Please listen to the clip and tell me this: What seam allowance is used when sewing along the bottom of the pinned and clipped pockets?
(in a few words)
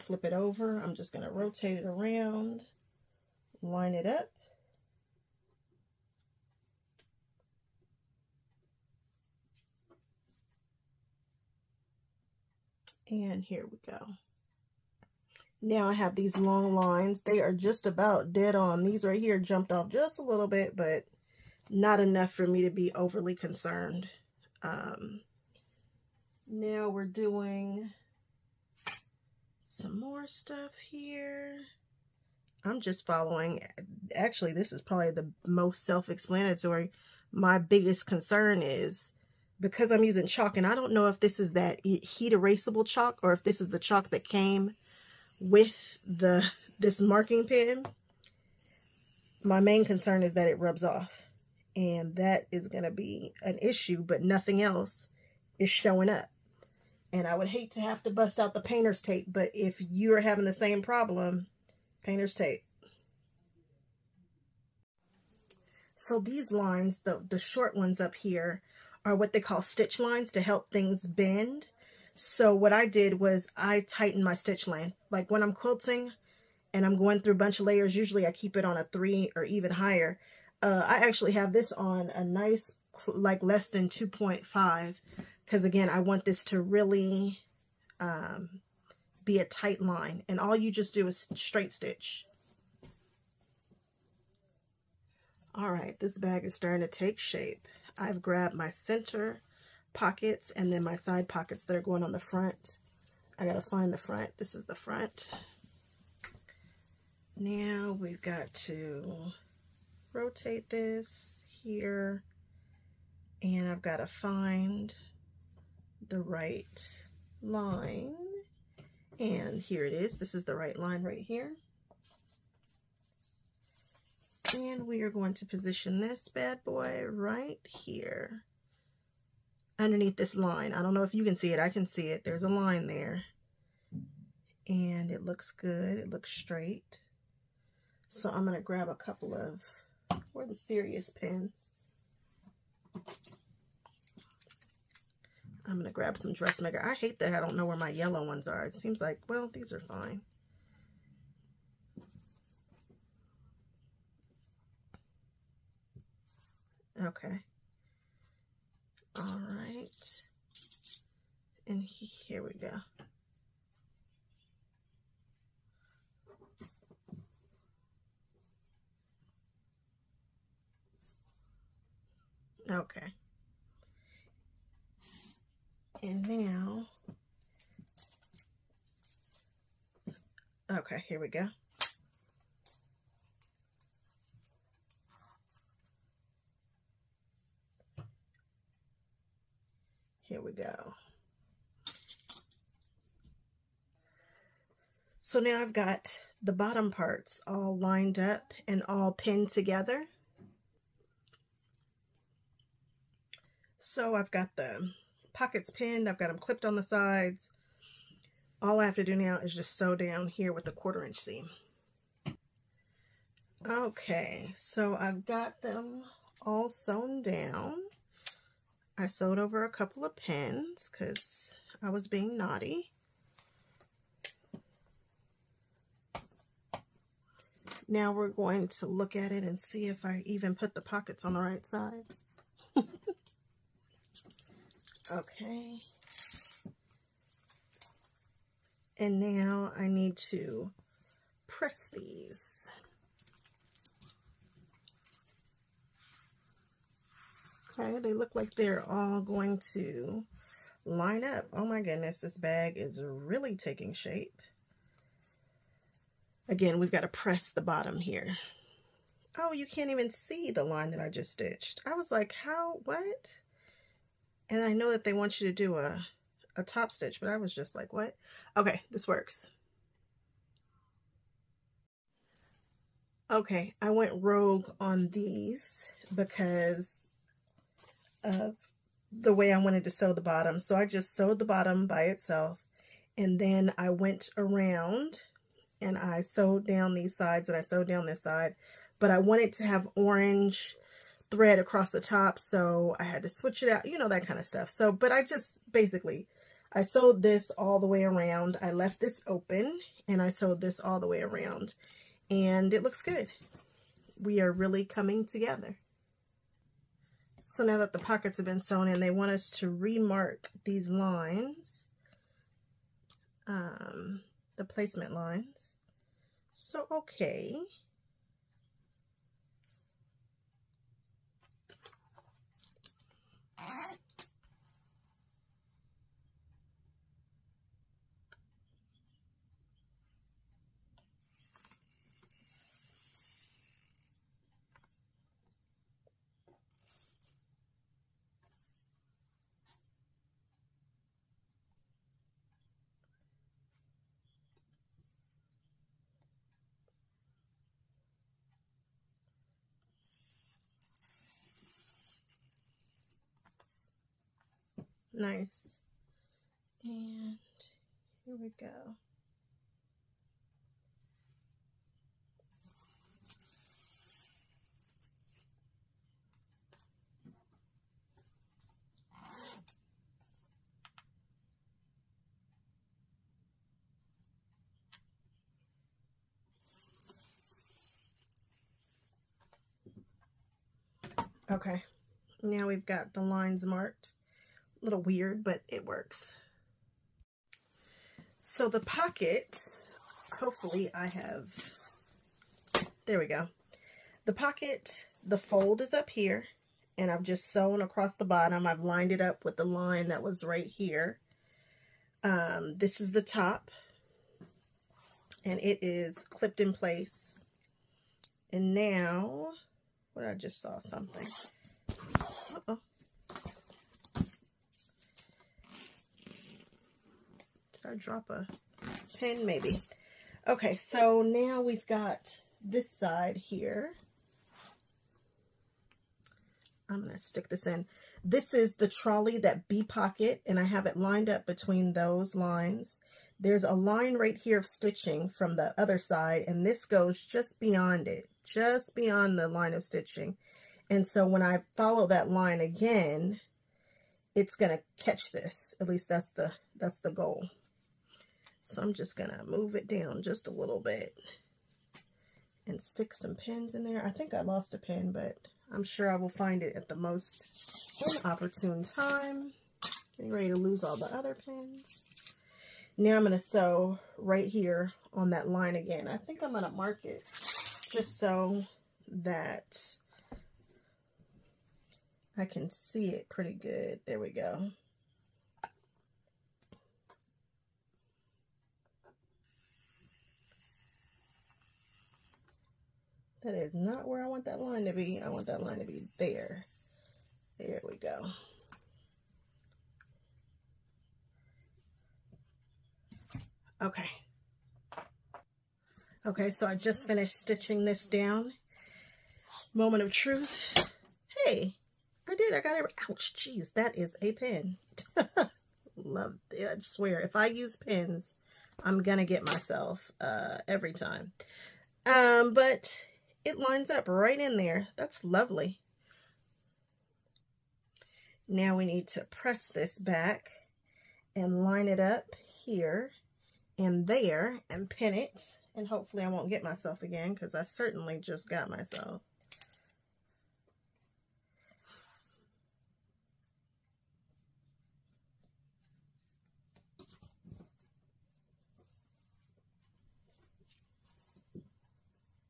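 quarter inch.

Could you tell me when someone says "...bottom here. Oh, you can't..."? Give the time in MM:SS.
04:17.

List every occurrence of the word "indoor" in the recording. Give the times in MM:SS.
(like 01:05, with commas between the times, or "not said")
not said.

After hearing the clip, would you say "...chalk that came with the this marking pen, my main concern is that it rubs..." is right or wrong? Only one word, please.
right.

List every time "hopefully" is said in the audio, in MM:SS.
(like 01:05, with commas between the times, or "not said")
06:30, 08:45.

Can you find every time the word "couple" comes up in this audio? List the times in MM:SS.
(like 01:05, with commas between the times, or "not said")
02:18, 03:39.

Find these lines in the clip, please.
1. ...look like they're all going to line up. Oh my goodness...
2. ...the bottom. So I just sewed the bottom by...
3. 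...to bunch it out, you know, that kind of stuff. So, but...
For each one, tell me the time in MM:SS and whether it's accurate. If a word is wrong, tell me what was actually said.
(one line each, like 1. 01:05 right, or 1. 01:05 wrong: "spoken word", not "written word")
1. 04:08 right
2. 04:40 right
3. 04:53 wrong: "switch", not "bunch".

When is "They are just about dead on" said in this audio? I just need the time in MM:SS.
00:17.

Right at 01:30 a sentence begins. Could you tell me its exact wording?
And all you just do is straight stitch.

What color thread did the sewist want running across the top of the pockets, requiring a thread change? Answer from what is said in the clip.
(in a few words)
orange.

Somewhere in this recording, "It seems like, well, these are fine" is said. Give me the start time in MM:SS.
02:28.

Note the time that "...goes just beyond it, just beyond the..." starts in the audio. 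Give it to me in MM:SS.
07:16.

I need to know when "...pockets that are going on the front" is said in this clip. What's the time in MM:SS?
01:41.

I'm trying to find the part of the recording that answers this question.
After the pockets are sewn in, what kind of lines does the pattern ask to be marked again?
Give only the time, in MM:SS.
05:14.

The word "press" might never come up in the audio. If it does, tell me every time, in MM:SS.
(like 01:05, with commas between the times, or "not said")
04:01, 04:17, 08:39.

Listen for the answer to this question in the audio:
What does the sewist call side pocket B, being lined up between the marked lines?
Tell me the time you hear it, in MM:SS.
07:08.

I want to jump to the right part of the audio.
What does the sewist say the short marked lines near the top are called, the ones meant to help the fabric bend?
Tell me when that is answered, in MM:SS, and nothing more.
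01:09.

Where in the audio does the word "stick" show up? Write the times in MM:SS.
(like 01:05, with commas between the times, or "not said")
07:07, 07:32.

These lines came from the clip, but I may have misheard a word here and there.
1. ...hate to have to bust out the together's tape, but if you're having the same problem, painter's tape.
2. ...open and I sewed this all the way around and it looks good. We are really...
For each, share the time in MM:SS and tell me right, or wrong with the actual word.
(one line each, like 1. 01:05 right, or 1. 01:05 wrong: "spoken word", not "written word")
1. 00:57 wrong: "painter", not "together"
2. 04:59 right.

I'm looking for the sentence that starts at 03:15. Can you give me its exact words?
So now I've got the bottom parts all lined up and all pinned together.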